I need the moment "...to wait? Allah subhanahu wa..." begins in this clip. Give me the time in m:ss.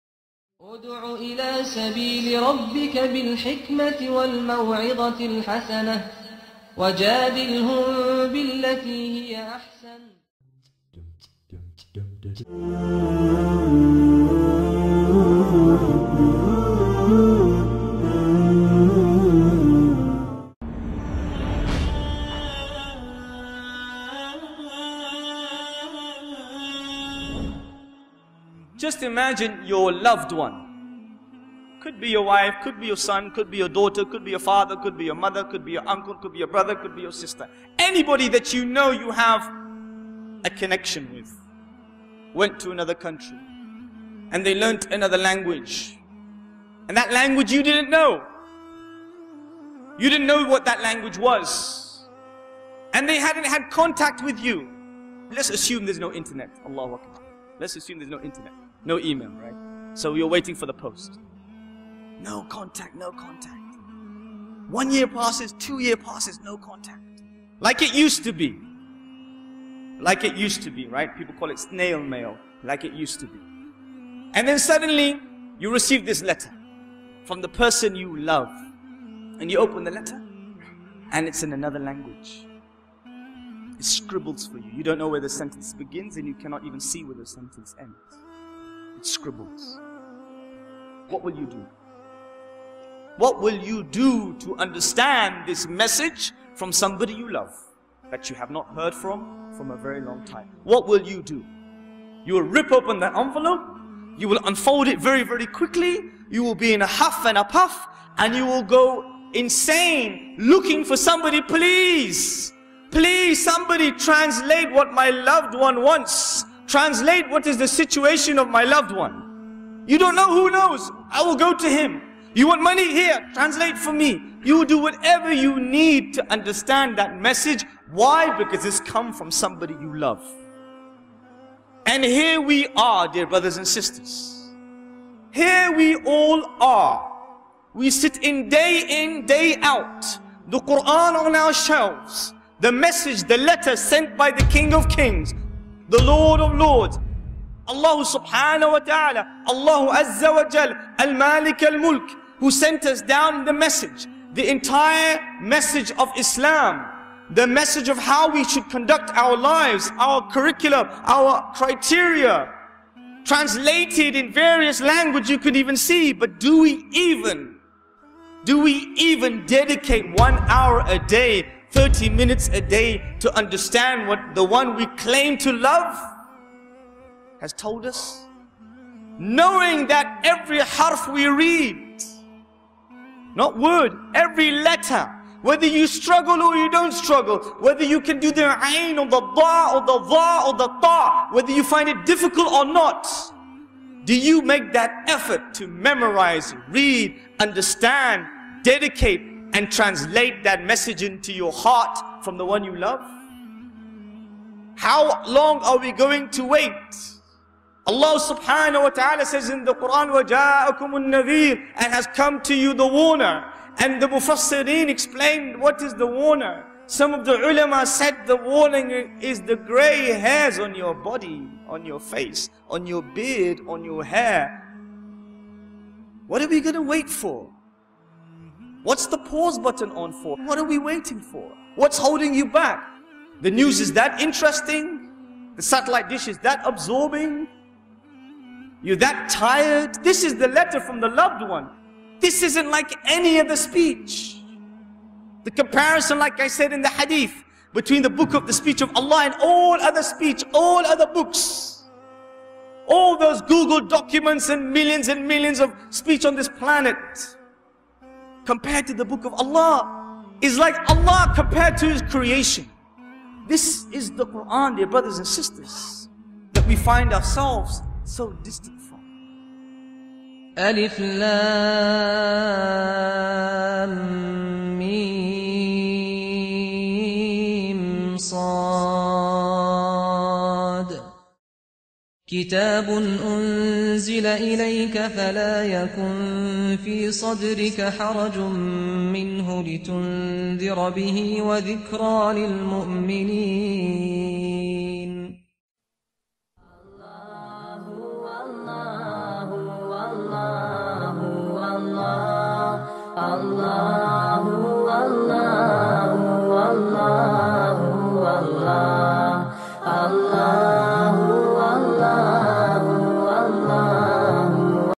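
3:26.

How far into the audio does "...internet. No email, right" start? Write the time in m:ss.
0:58.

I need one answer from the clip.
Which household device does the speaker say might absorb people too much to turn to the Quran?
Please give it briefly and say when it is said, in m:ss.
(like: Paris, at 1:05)
satellite dish, at 3:55.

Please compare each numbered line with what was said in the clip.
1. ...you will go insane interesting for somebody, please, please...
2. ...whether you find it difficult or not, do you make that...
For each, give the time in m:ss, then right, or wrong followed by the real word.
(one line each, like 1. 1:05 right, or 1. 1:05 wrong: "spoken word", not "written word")
1. 1:48 wrong: "looking", not "interesting"
2. 3:11 right.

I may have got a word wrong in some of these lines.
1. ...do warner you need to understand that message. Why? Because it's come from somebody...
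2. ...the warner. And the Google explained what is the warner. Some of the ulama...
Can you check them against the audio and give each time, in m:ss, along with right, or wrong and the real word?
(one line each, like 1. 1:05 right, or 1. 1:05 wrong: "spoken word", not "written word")
1. 2:04 wrong: "whatever", not "warner"
2. 3:32 wrong: "Mufassirin", not "Google".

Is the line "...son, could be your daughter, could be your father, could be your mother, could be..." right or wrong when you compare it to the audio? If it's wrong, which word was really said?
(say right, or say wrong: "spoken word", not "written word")
right.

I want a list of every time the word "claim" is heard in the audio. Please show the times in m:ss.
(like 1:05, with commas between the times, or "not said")
2:54.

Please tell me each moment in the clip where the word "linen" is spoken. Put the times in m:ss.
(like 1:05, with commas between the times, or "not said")
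not said.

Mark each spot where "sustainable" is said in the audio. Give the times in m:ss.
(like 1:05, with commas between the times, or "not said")
not said.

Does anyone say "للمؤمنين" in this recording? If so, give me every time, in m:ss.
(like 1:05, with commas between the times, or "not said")
4:52.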